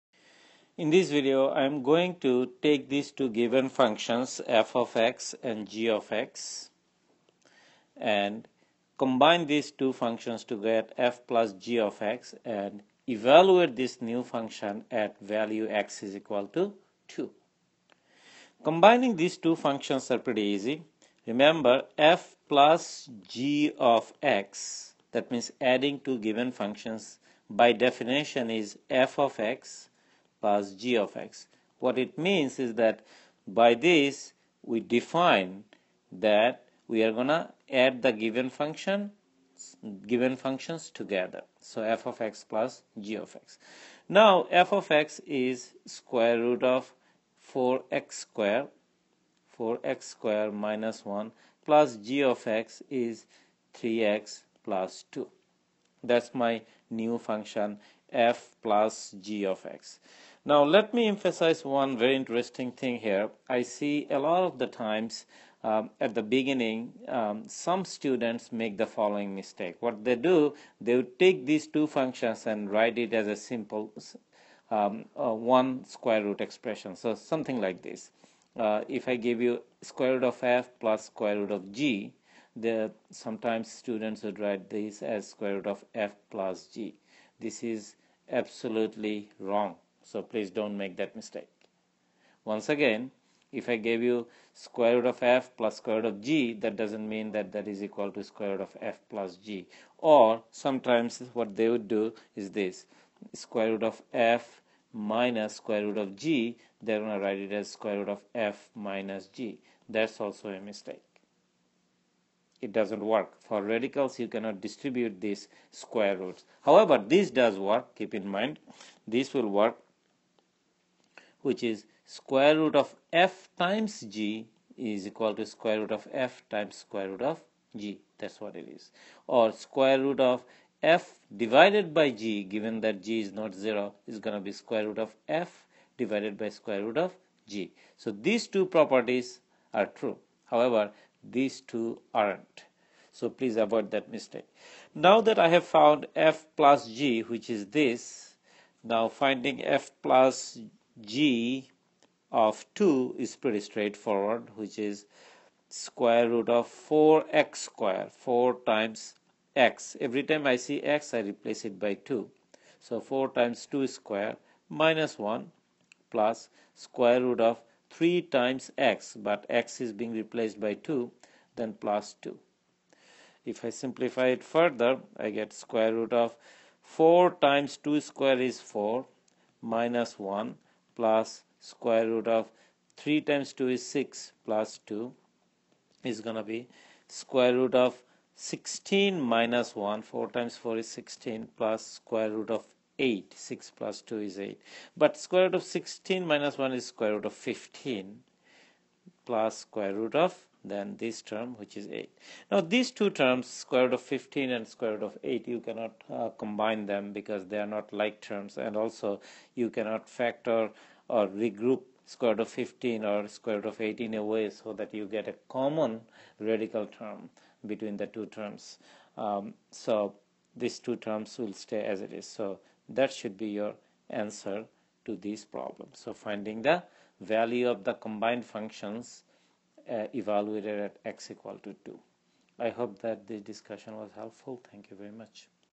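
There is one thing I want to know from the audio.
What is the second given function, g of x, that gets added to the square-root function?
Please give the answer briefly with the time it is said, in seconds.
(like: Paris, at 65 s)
3x + 2, at 53 s.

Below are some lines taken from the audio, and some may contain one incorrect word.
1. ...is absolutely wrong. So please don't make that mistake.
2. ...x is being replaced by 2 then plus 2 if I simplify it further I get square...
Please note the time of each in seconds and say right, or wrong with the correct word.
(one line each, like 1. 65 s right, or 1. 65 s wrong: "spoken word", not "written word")
1. 87 s right
2. 169 s right.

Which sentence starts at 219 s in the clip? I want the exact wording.
Um, so these two terms will stay as it is.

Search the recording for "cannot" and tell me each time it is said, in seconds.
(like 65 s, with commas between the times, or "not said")
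114 s, 205 s, 209 s.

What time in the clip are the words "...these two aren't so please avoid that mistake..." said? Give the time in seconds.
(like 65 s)
141 s.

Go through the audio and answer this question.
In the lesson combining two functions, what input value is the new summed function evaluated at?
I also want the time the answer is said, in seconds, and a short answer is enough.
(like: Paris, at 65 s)
2, at 15 s.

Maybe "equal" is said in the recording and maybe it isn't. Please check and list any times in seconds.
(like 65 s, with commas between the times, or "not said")
16 s, 97 s, 125 s, 231 s.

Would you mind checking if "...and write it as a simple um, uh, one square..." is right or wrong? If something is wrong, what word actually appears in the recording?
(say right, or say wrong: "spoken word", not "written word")
right.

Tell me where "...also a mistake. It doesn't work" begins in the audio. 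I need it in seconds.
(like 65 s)
110 s.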